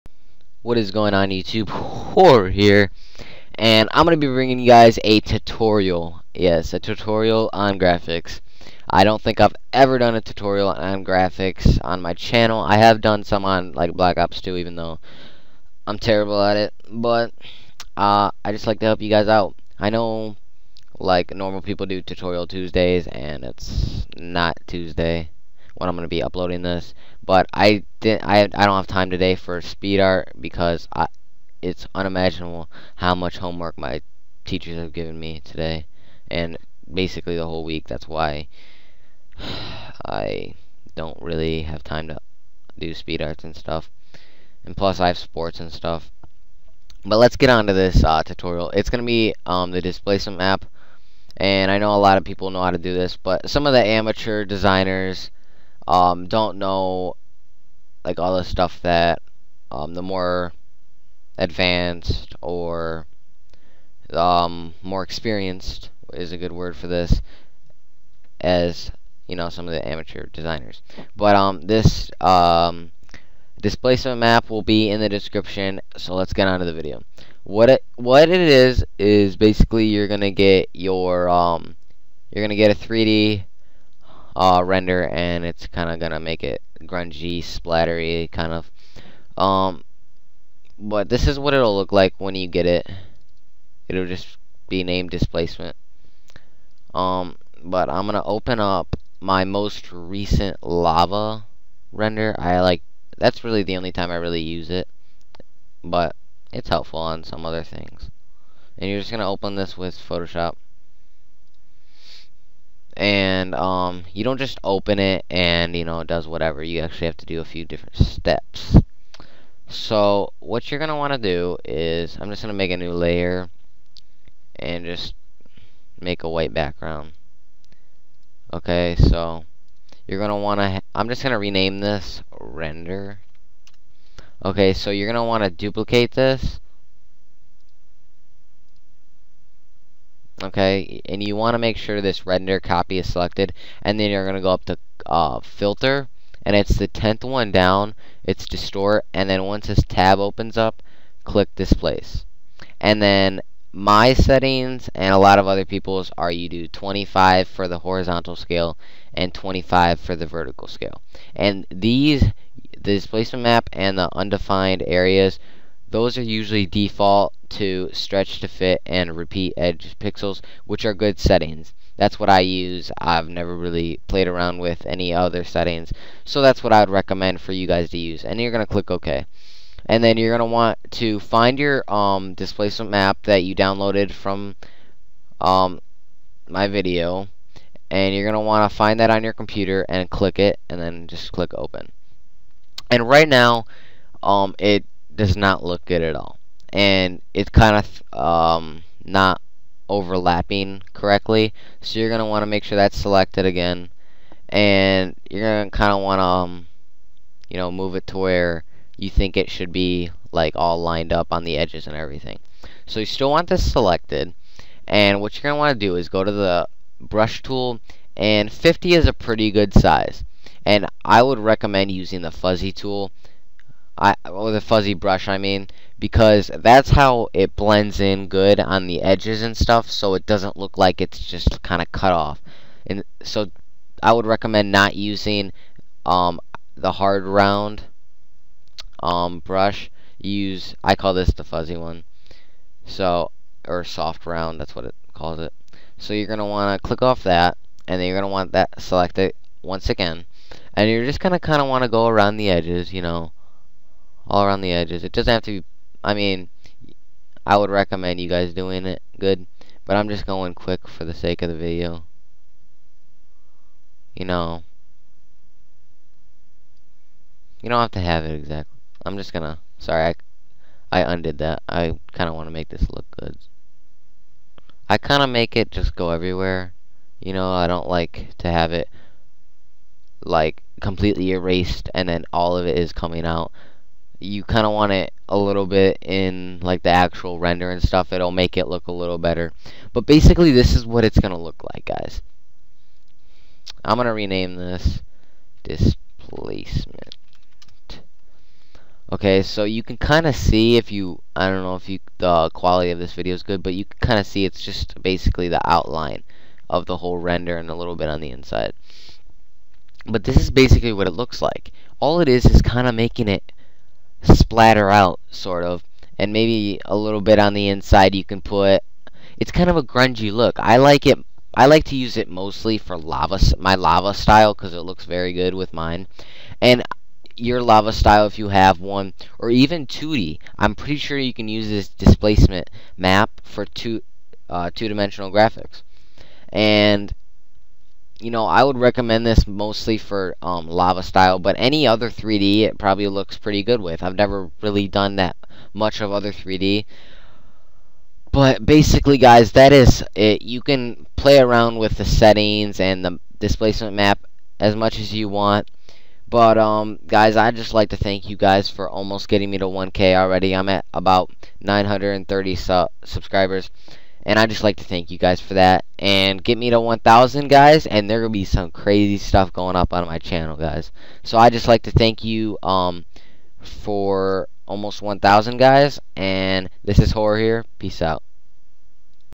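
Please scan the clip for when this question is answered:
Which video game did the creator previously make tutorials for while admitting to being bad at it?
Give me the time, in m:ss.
0:13.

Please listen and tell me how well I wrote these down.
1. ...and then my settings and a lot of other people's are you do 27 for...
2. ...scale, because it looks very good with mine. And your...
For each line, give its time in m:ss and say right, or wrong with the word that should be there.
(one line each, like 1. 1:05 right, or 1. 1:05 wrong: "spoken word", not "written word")
1. 2:32 wrong: "25", not "27"
2. 5:24 wrong: "style", not "scale".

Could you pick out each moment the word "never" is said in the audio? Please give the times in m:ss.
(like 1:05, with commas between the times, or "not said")
2:53, 5:44.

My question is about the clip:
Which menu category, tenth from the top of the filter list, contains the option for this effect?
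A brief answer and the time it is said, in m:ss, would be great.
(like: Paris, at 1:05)
distort, at 2:28.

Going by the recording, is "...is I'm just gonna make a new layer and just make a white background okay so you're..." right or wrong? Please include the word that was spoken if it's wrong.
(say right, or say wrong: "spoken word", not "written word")
right.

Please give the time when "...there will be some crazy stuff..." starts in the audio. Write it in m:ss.
6:08.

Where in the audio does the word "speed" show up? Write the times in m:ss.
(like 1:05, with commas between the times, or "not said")
0:29, 0:42.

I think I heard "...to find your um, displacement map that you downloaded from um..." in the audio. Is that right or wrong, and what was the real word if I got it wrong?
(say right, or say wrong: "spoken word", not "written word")
right.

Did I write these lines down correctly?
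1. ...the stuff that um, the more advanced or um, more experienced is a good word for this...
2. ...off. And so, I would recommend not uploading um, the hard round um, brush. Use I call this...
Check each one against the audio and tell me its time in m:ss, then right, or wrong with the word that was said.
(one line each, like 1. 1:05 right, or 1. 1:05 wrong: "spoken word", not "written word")
1. 0:58 right
2. 3:52 wrong: "using", not "uploading".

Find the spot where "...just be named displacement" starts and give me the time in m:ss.
1:34.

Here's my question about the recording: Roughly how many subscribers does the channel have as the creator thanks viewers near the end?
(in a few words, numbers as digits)
930.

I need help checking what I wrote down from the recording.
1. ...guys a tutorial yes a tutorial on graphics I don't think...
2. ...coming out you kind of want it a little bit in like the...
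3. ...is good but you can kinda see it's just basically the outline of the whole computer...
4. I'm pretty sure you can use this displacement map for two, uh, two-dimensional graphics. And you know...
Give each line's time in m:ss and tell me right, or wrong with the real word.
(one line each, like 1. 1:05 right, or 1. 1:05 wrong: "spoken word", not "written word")
1. 0:04 right
2. 4:42 right
3. 5:03 wrong: "render", not "computer"
4. 5:30 right.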